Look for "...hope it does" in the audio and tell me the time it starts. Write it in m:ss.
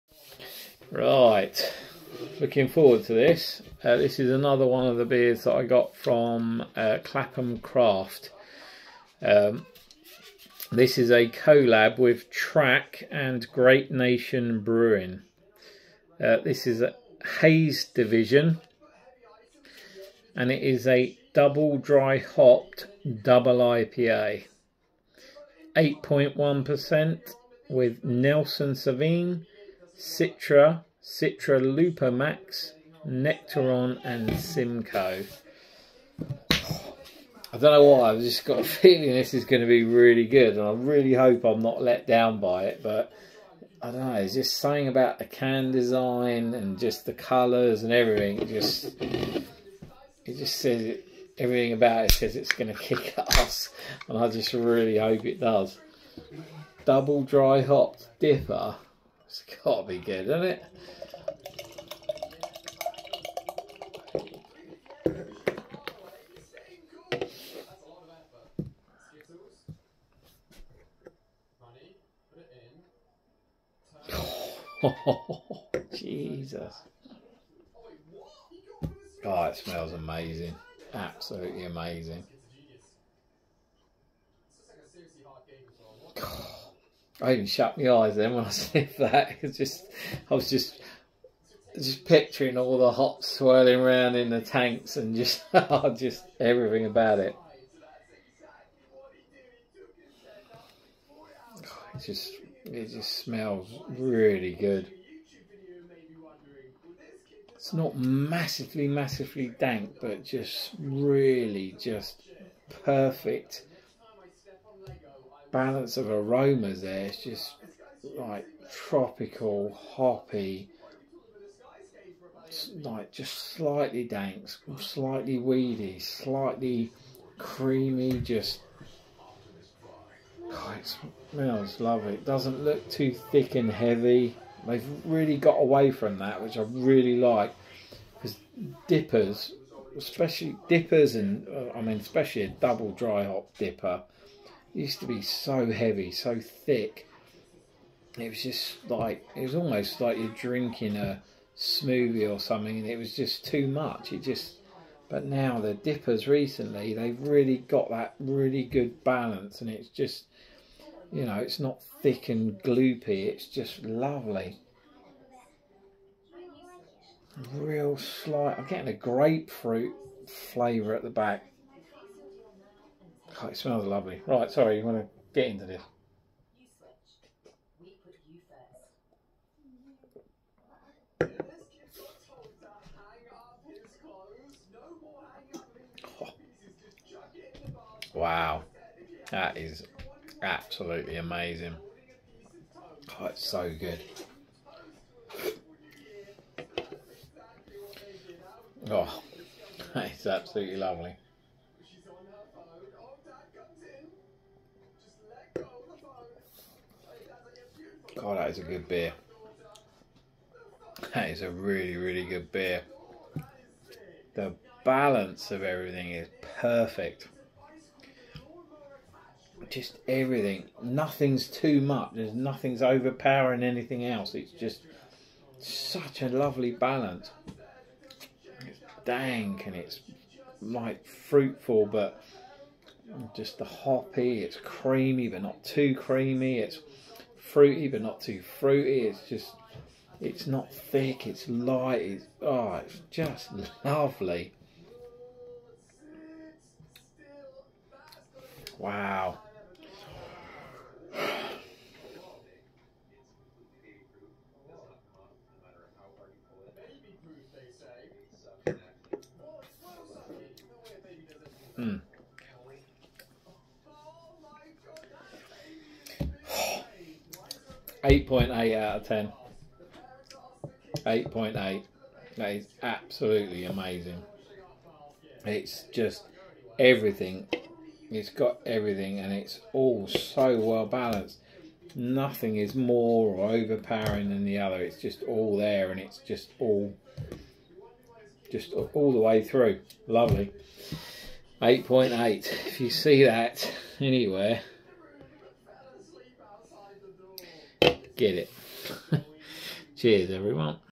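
0:54.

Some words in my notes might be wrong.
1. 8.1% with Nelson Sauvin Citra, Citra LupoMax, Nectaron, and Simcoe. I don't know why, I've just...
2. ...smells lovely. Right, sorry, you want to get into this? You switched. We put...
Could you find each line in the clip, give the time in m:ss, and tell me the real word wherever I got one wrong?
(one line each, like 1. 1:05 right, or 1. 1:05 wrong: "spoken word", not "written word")
1. 0:25 right
2. 2:53 right.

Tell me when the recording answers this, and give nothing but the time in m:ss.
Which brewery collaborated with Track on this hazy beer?
0:13.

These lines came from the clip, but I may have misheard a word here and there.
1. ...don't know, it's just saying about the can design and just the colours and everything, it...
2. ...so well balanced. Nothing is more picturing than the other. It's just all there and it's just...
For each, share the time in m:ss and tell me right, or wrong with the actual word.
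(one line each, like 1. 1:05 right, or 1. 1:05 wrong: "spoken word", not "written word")
1. 0:43 right
2. 4:40 wrong: "overpowering", not "picturing".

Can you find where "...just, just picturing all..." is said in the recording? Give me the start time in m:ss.
1:30.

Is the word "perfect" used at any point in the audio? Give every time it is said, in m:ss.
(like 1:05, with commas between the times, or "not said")
1:52, 3:36.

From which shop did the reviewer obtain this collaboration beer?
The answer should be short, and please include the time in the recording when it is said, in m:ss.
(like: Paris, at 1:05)
Clapham Craft, at 0:07.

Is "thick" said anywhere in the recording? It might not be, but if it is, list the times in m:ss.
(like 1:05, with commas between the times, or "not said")
2:13, 2:26, 2:42, 4:00.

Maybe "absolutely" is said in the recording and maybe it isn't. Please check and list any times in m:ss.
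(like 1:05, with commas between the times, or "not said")
3:10, 3:20, 4:32.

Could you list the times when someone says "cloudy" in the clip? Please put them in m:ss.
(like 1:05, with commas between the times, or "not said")
not said.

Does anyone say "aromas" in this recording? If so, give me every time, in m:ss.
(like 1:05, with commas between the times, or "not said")
1:56.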